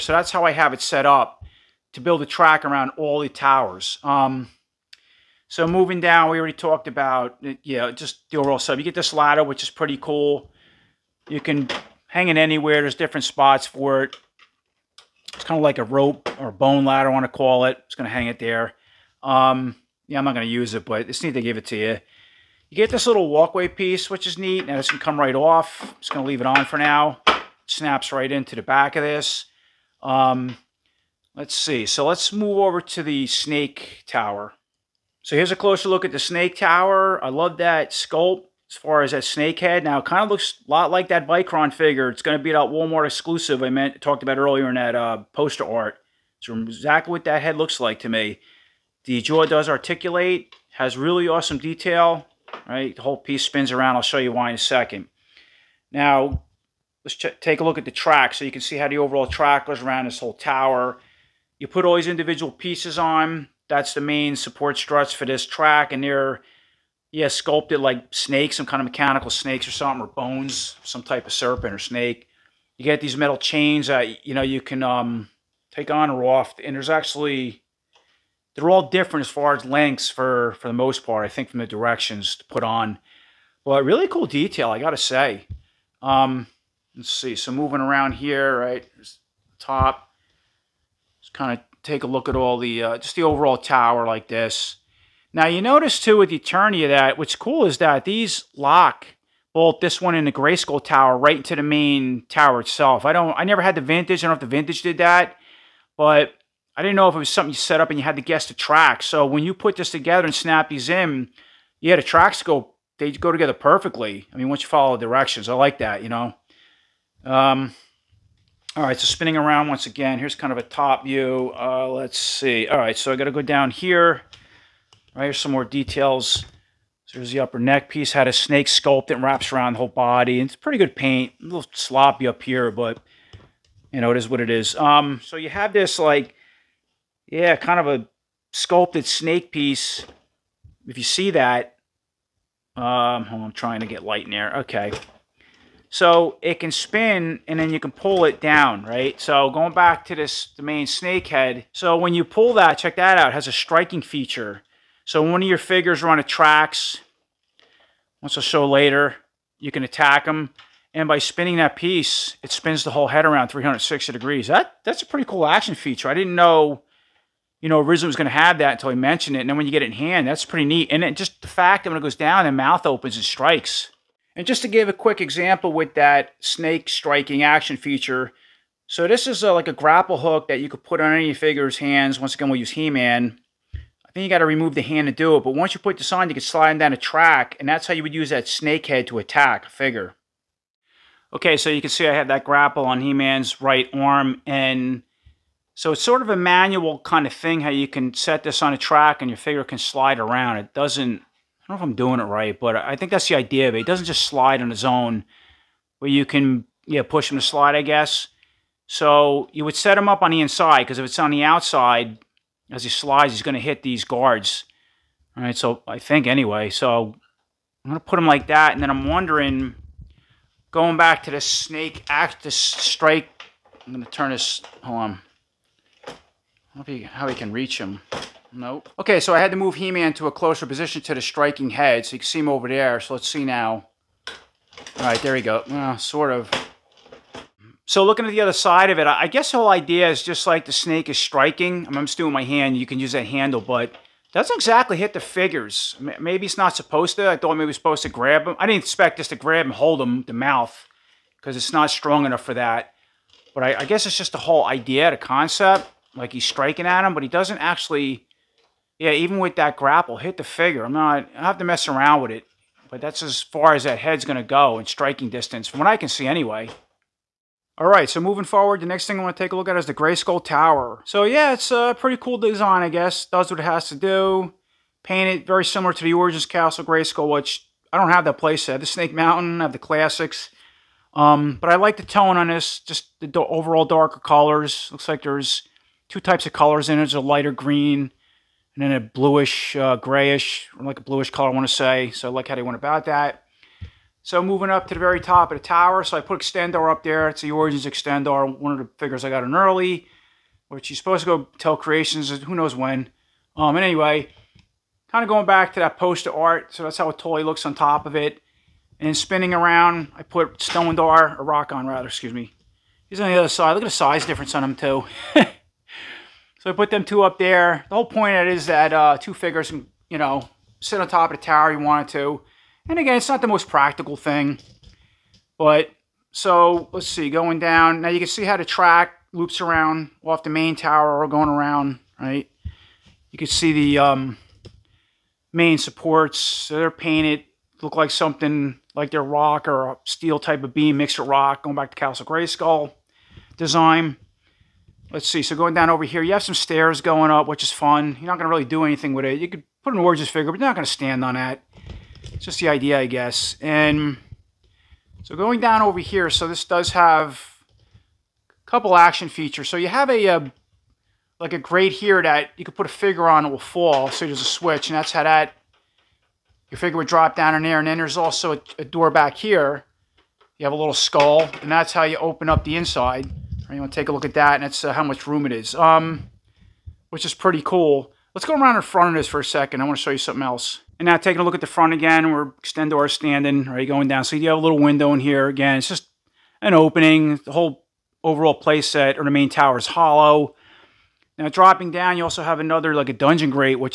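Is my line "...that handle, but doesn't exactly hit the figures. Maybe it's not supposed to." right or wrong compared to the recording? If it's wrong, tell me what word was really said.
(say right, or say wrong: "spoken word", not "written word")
right.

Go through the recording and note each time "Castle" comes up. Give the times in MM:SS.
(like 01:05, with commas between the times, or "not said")
04:36, 05:41.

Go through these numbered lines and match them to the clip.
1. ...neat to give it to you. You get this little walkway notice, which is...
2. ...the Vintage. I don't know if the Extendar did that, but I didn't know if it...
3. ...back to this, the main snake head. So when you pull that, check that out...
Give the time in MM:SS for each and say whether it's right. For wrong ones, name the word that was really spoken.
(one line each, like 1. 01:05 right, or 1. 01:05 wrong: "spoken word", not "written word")
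1. 00:21 wrong: "piece", not "notice"
2. 01:43 wrong: "Vintage", not "Extendar"
3. 02:29 right.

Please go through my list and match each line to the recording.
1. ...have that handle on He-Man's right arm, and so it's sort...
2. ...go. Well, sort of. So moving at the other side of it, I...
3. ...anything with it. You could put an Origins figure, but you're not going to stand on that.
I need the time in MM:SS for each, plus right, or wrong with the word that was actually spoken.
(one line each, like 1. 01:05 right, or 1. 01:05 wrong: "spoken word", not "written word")
1. 03:12 wrong: "grapple", not "handle"
2. 03:55 wrong: "looking", not "moving"
3. 05:48 right.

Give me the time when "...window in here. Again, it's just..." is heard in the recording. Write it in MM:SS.
06:24.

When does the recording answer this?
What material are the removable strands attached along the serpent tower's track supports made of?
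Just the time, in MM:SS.
01:13.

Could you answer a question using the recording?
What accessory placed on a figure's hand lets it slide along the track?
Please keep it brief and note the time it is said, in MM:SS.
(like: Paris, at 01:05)
Grapple hook, at 02:59.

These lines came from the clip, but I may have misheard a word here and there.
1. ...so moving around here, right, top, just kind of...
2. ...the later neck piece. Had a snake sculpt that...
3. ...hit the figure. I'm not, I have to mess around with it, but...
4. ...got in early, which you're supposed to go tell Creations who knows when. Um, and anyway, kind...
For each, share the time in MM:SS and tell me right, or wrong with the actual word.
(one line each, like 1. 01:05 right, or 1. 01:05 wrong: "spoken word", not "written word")
1. 01:27 right
2. 02:07 wrong: "upper", not "later"
3. 04:20 right
4. 04:59 right.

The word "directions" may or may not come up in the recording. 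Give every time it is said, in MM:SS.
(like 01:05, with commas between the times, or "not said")
01:21, 01:55.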